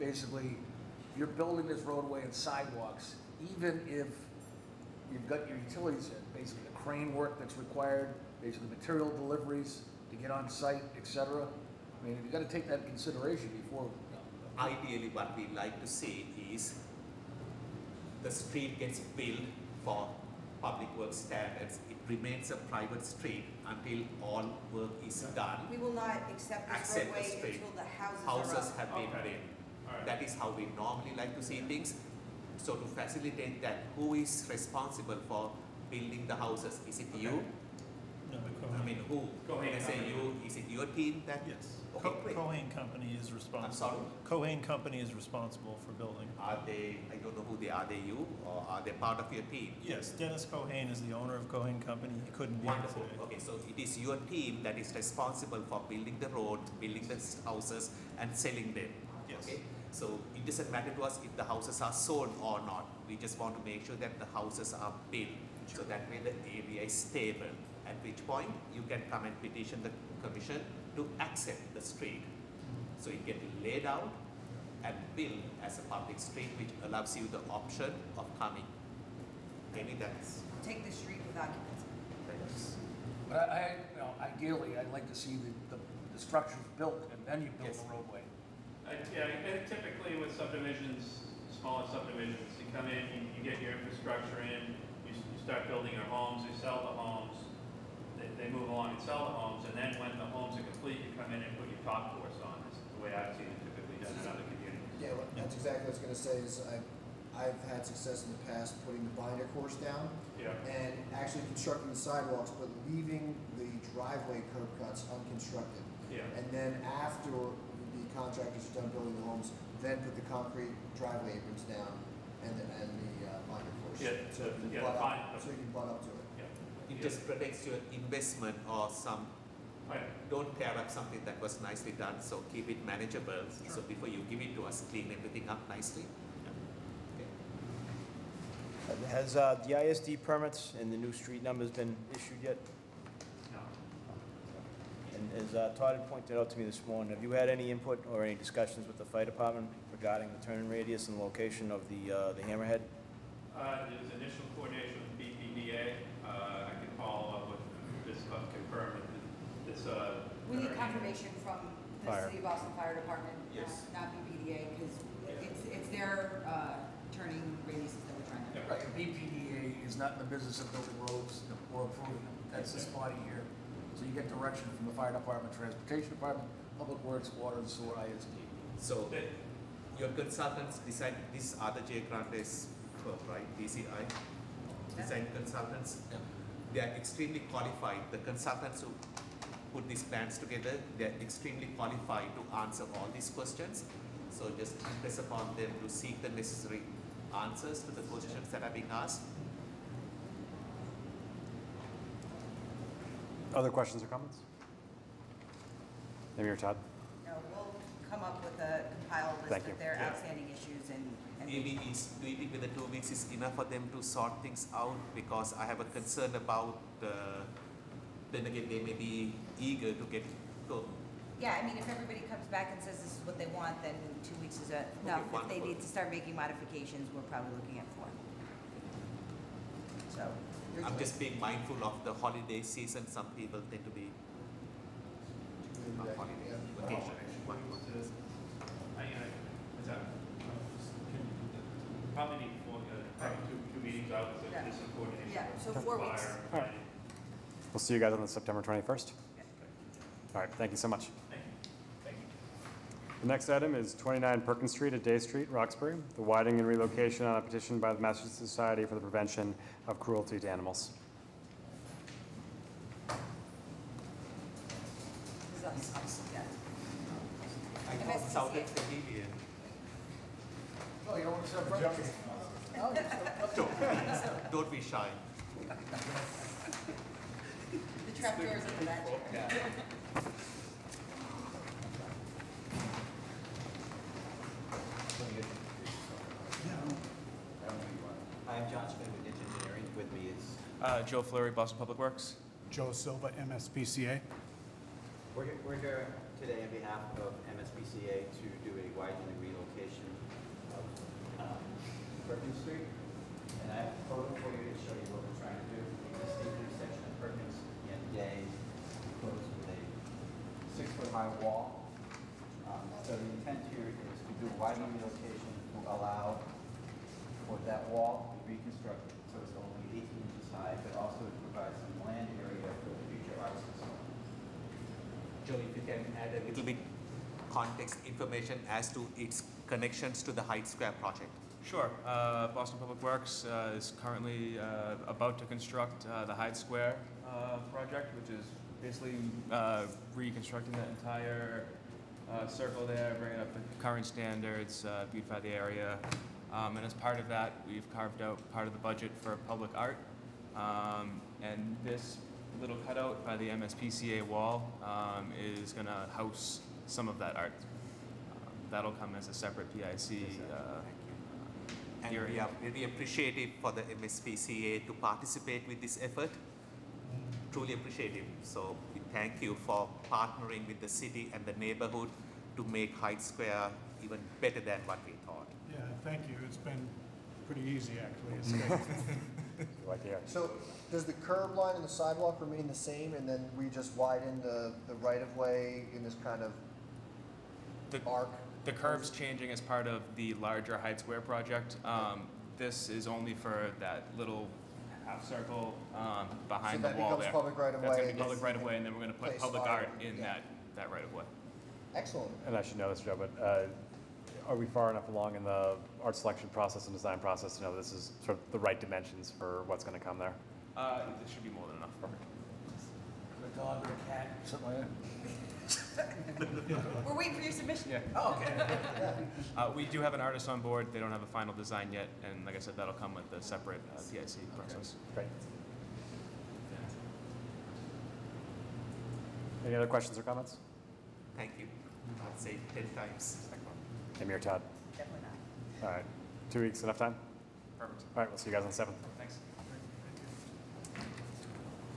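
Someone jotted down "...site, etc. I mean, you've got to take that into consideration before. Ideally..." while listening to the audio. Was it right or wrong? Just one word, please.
right.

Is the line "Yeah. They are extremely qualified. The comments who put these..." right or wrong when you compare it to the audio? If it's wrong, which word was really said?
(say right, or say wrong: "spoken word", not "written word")
wrong: "consultants", not "comments".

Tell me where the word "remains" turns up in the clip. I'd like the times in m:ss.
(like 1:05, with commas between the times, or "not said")
0:22, 6:22.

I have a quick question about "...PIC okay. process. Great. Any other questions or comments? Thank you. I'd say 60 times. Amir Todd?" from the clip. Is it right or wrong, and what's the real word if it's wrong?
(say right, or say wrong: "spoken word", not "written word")
wrong: "10", not "60".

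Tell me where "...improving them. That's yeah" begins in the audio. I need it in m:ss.
2:51.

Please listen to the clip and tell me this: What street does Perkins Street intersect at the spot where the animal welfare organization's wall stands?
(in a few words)
Day Street.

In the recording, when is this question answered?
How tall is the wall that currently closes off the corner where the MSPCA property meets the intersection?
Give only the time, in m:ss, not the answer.
5:10.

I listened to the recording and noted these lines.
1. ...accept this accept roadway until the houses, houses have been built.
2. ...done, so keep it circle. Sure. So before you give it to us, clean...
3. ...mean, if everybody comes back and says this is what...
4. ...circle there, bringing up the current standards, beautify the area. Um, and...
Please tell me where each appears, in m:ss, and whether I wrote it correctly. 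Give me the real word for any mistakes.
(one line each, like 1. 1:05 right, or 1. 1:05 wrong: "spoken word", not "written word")
1. 0:26 right
2. 2:11 wrong: "manageable", not "circle"
3. 3:41 right
4. 5:42 right.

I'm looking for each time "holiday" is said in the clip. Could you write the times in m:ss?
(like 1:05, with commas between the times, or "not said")
3:52, 3:56.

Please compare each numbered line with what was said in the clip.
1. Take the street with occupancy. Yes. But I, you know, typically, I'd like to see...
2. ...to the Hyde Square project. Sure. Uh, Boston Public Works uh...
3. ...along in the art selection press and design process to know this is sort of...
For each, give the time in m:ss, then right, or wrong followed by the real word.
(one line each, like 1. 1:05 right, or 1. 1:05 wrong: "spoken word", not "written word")
1. 1:20 wrong: "ideally", not "typically"
2. 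5:30 right
3. 6:45 wrong: "process", not "press".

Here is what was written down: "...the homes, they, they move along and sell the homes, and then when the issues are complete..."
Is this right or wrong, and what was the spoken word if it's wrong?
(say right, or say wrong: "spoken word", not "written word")
wrong: "homes", not "issues".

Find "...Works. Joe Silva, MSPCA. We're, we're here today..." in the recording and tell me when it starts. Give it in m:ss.
4:51.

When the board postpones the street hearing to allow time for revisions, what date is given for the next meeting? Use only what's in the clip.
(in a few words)
September 21st.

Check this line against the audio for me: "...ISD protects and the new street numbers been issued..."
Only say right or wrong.
wrong.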